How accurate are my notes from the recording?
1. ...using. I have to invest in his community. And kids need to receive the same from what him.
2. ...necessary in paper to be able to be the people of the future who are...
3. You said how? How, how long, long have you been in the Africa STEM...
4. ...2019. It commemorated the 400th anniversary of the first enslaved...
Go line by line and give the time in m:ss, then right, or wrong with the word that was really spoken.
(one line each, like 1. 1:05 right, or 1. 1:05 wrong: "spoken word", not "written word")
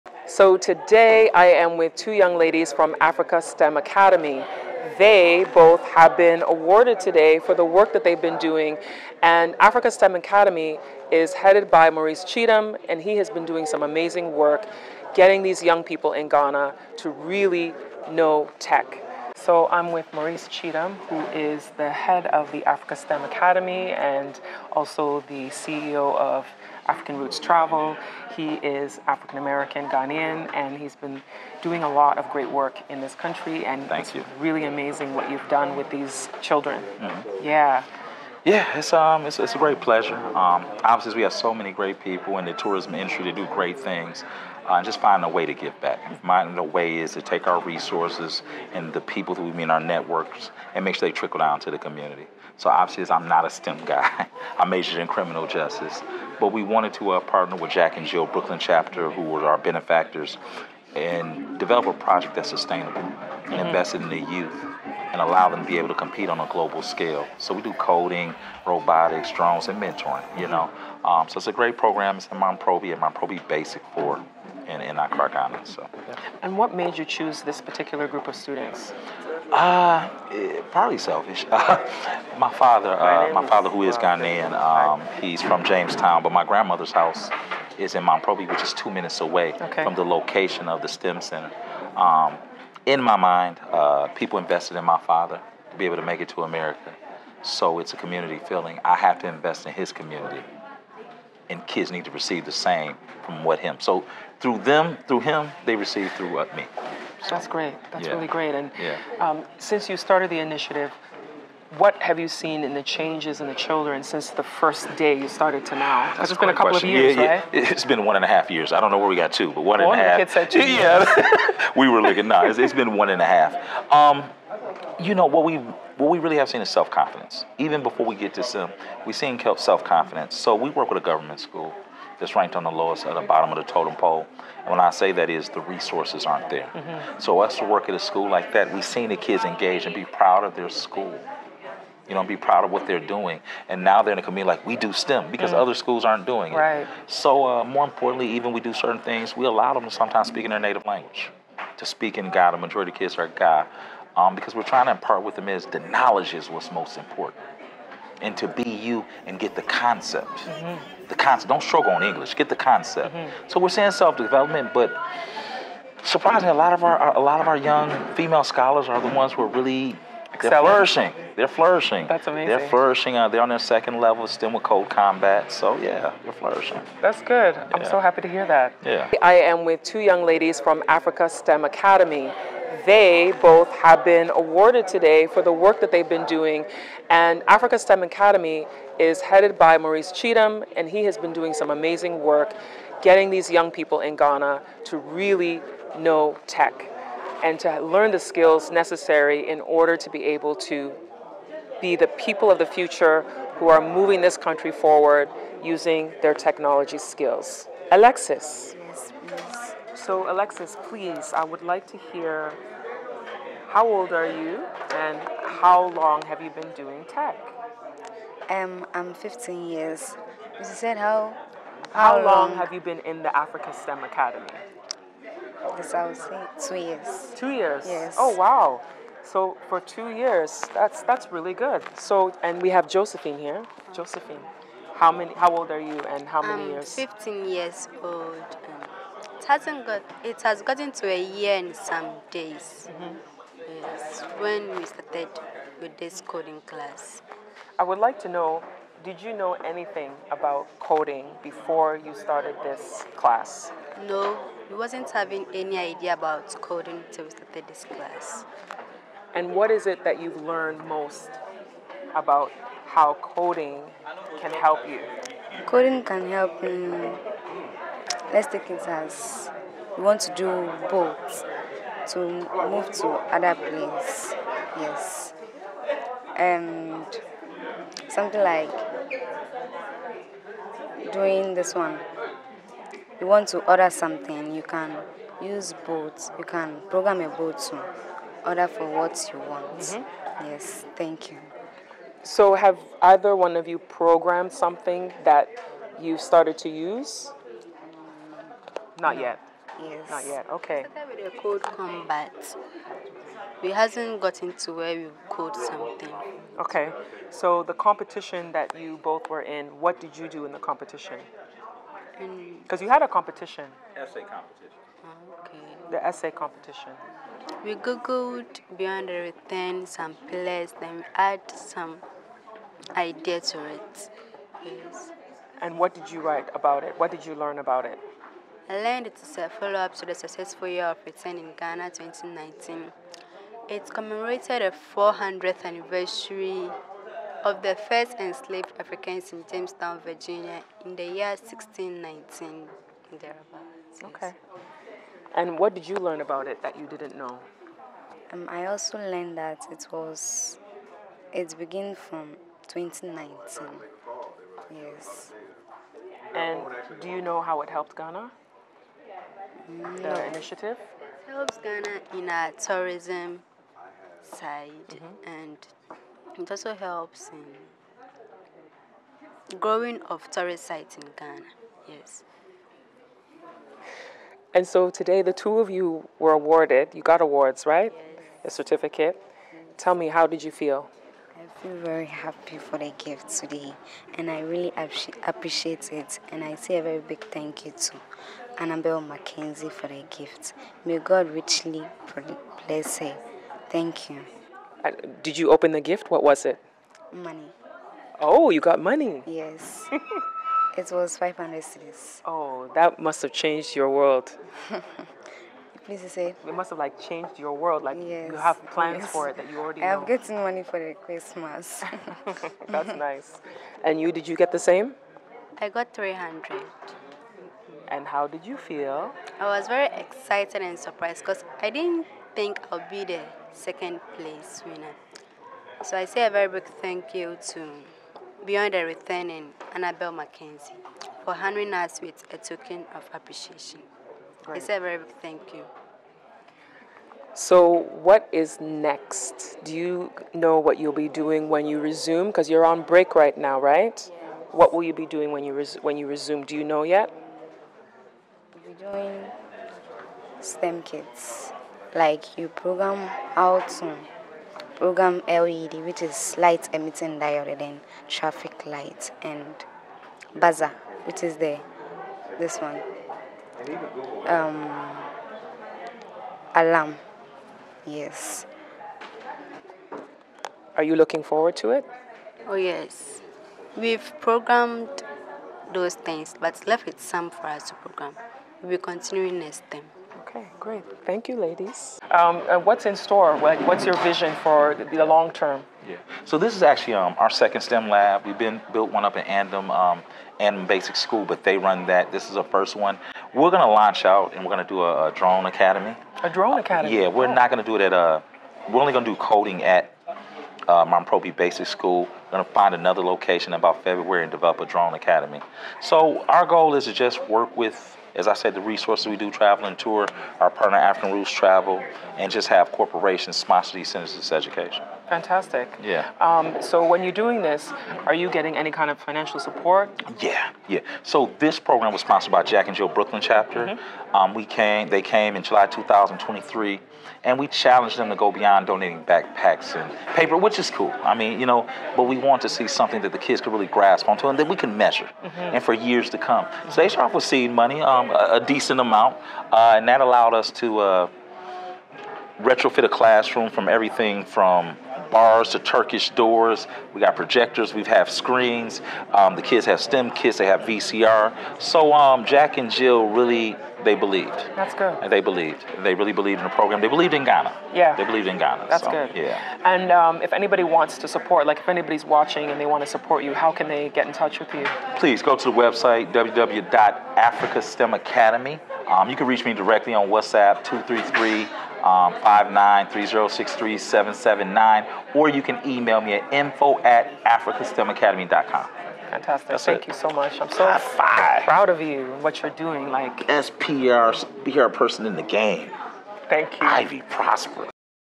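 1. 1:38 wrong: "feeling", not "using"
2. 3:18 wrong: "order", not "paper"
3. 3:40 right
4. 5:31 right.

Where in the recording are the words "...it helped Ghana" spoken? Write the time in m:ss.
5:57.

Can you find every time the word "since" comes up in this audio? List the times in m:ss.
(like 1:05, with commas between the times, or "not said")
1:49, 1:54.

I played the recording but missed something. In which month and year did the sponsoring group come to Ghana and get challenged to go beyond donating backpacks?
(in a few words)
July 2023.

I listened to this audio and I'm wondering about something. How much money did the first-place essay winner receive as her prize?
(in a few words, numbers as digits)
500 cedis.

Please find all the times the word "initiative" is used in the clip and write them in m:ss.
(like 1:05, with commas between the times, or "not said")
1:50, 6:00.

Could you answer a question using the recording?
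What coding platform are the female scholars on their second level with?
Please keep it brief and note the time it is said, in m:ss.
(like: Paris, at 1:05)
CodeCombat, at 2:54.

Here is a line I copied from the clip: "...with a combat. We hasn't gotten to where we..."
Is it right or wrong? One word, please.
right.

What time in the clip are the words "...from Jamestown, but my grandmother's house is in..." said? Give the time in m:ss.
1:25.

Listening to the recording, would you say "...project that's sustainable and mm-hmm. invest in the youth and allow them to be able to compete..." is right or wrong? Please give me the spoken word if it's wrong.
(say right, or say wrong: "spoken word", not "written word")
right.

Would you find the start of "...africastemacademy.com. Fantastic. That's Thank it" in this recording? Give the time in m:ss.
9:37.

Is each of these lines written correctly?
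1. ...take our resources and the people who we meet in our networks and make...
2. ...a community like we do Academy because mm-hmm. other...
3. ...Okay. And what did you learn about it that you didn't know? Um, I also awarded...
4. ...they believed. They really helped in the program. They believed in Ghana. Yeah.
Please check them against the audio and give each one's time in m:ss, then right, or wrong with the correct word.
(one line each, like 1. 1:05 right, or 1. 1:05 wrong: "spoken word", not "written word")
1. 0:47 right
2. 2:24 wrong: "STEM", not "Academy"
3. 5:44 wrong: "learned", not "awarded"
4. 9:15 wrong: "believed", not "helped".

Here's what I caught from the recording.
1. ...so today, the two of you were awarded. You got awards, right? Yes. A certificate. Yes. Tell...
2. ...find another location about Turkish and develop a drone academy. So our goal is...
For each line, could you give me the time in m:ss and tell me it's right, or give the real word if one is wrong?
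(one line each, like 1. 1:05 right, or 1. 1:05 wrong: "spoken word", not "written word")
1. 6:14 right
2. 8:22 wrong: "February", not "Turkish".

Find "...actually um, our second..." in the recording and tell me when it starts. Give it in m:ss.
8:06.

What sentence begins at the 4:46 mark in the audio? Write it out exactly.
You can program a boat to order for what you want.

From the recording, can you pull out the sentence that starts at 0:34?
really amazing what you've done with these children.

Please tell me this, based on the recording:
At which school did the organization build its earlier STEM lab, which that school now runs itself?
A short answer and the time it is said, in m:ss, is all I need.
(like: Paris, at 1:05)
Andam Basic School, at 8:10.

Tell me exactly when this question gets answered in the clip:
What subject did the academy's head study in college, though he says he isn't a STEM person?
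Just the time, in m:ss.
0:55.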